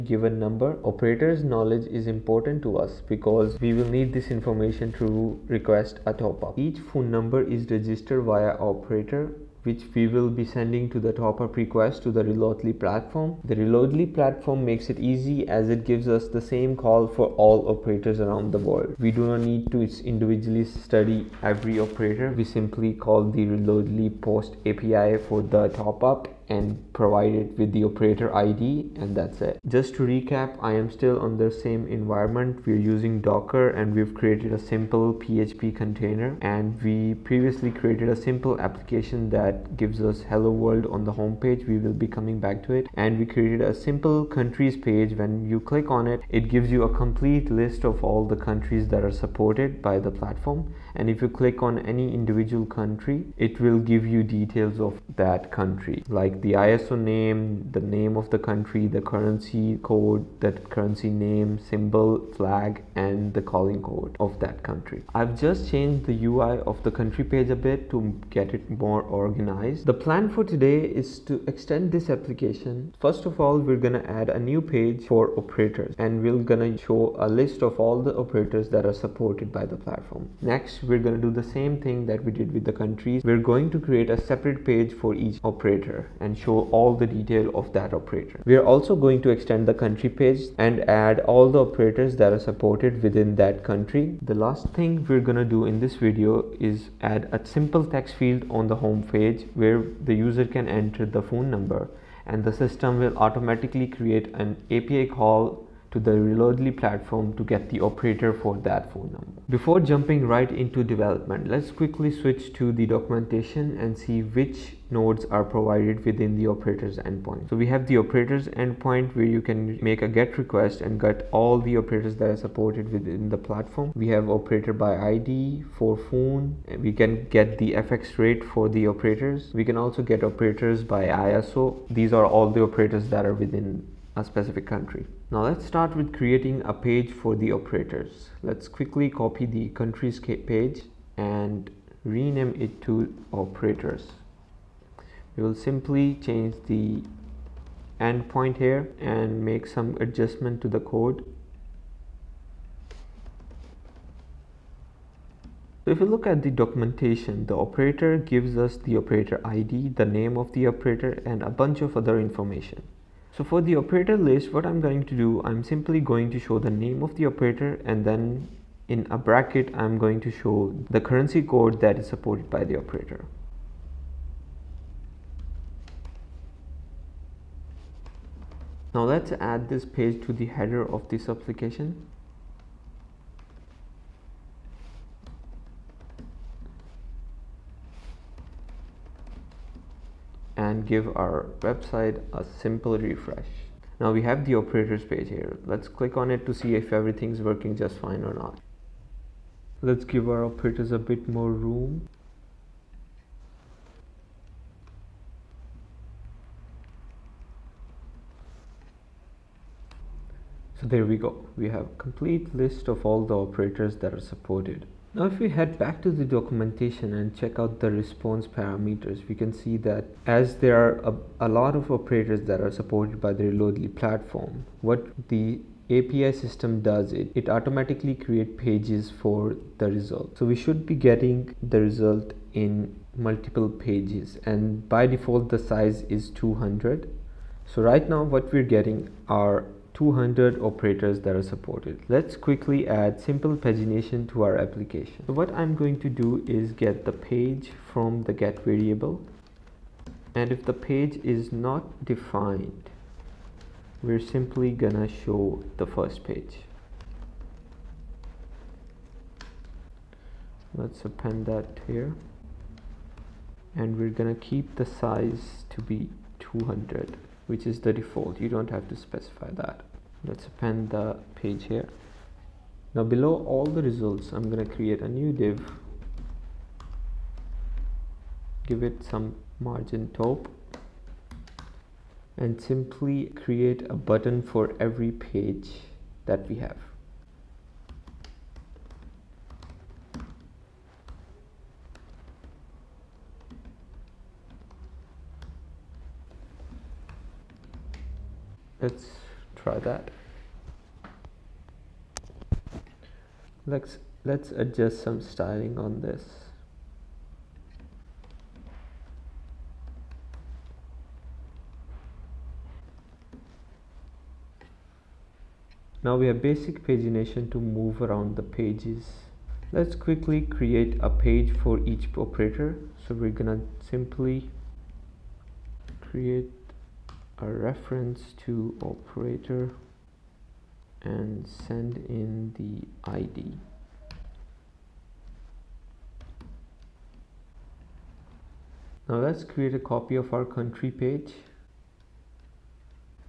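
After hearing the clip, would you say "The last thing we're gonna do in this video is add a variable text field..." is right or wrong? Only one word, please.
wrong.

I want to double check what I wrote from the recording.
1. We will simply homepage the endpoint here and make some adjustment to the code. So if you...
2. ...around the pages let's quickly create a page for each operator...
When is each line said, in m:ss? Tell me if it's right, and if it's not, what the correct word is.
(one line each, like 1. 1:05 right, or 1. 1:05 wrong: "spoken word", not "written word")
1. 2:25 wrong: "change", not "homepage"
2. 5:18 right.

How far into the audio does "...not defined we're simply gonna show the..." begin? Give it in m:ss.
4:11.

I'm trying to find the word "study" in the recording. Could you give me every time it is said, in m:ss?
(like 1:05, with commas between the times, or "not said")
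0:20.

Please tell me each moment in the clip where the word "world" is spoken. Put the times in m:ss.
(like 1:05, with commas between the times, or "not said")
0:18, 0:40.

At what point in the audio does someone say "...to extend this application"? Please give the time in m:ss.
1:11.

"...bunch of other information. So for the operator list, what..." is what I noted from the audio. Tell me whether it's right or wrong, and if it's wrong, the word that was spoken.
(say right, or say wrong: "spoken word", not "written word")
right.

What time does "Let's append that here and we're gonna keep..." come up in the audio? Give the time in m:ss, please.
4:20.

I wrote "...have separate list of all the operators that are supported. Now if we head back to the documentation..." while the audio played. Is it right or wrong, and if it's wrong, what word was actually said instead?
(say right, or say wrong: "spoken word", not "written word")
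wrong: "complete", not "separate".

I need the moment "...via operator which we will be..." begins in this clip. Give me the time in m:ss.
0:08.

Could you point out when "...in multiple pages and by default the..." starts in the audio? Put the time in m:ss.
3:52.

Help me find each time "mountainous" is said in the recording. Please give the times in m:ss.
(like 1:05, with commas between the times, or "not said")
not said.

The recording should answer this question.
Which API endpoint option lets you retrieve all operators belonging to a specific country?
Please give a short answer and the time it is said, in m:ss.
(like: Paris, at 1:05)
operators by ISO, at 2:10.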